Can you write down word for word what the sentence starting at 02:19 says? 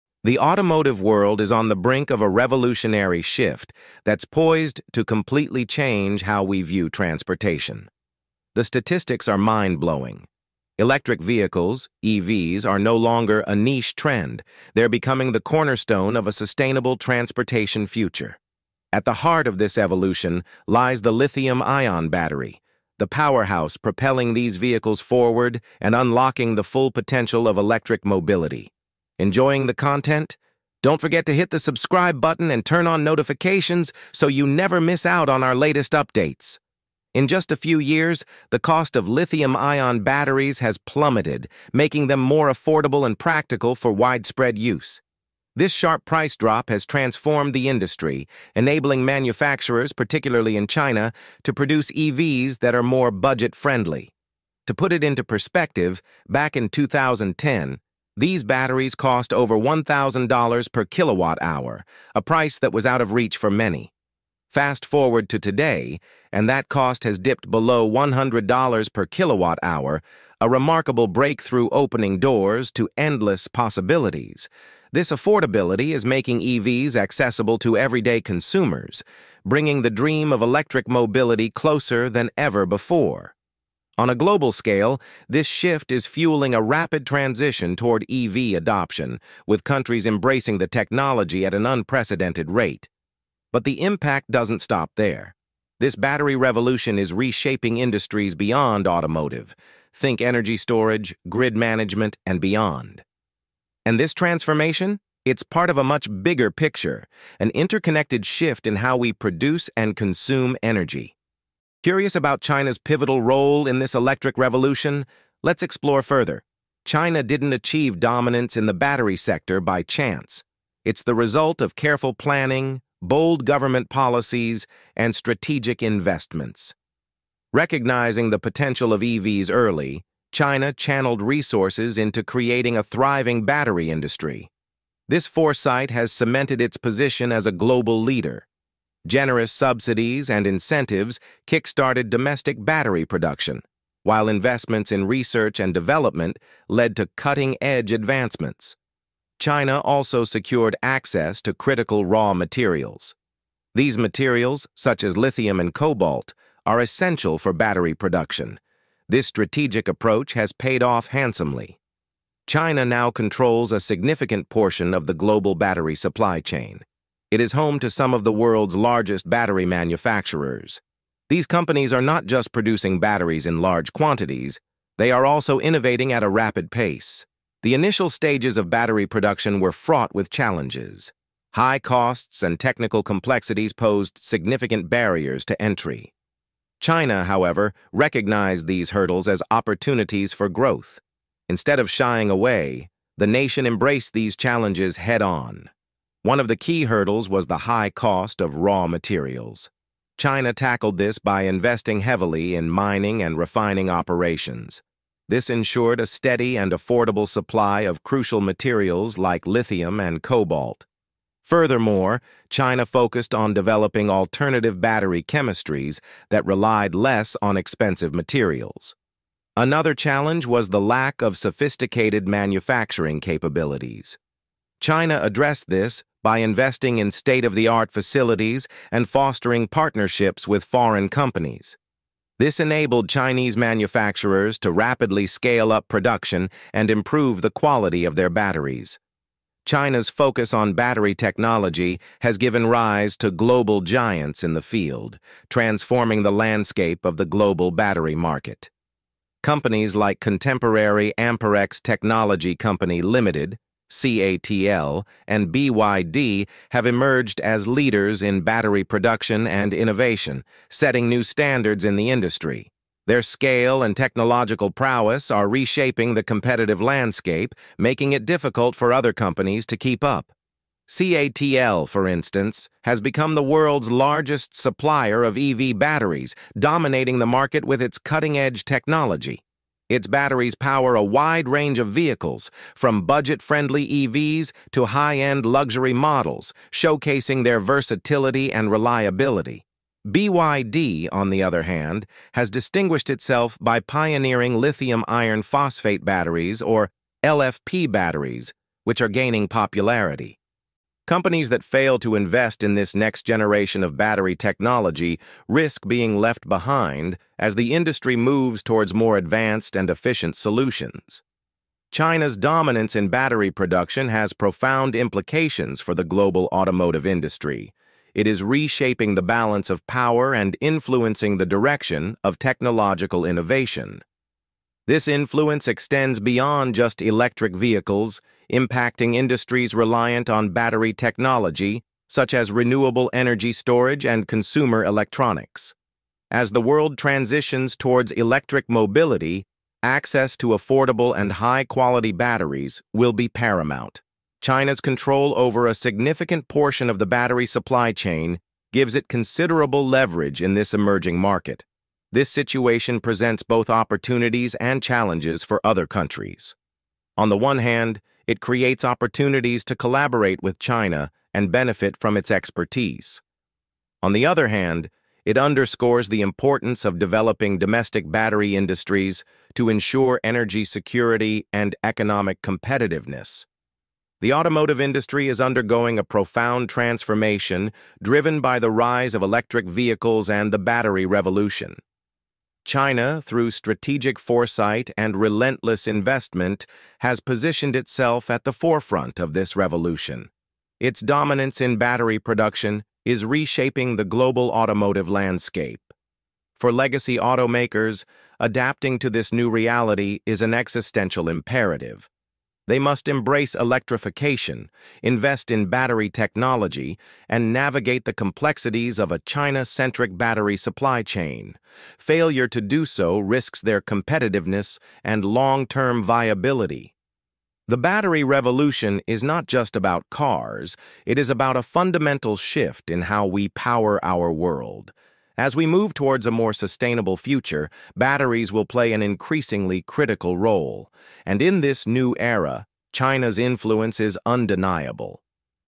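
Generous subsidies and incentives kickstarted domestic battery production, while investments in research and development led to cutting-edge advancements.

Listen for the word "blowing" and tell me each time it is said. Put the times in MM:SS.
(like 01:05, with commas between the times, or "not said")
00:09.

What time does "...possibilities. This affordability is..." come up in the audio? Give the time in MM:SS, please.
01:13.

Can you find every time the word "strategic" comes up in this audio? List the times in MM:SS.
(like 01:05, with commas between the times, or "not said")
02:05, 02:39, 06:23.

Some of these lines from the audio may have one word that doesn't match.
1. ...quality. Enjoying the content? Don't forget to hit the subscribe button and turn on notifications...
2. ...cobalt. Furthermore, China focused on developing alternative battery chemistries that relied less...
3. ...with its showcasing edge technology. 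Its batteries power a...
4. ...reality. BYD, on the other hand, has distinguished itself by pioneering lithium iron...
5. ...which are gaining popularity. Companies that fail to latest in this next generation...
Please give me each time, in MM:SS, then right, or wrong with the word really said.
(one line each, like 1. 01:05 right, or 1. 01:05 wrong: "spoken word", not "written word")
1. 00:28 wrong: "mobility", not "quality"
2. 03:30 right
3. 04:37 wrong: "cutting", not "showcasing"
4. 04:48 wrong: "reliability", not "reality"
5. 04:58 wrong: "invest", not "latest".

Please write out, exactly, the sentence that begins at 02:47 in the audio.
It is home to some of the world's largest battery manufacturers.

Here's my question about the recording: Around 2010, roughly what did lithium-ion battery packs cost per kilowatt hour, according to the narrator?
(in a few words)
over $1,000.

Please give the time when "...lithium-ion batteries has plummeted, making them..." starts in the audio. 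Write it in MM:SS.
00:39.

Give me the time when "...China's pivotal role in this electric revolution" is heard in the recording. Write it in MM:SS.
01:52.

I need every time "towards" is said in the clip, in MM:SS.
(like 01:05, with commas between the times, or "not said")
01:27, 05:08, 05:37, 07:05.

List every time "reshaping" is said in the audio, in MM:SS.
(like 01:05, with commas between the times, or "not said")
01:37, 04:25, 05:18, 06:33.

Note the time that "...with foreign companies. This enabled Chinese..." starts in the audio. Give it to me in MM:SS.
03:50.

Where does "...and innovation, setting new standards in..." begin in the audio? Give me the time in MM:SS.
04:19.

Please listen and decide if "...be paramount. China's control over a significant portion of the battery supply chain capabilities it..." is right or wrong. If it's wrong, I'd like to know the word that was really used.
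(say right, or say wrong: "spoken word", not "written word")
wrong: "gives", not "capabilities".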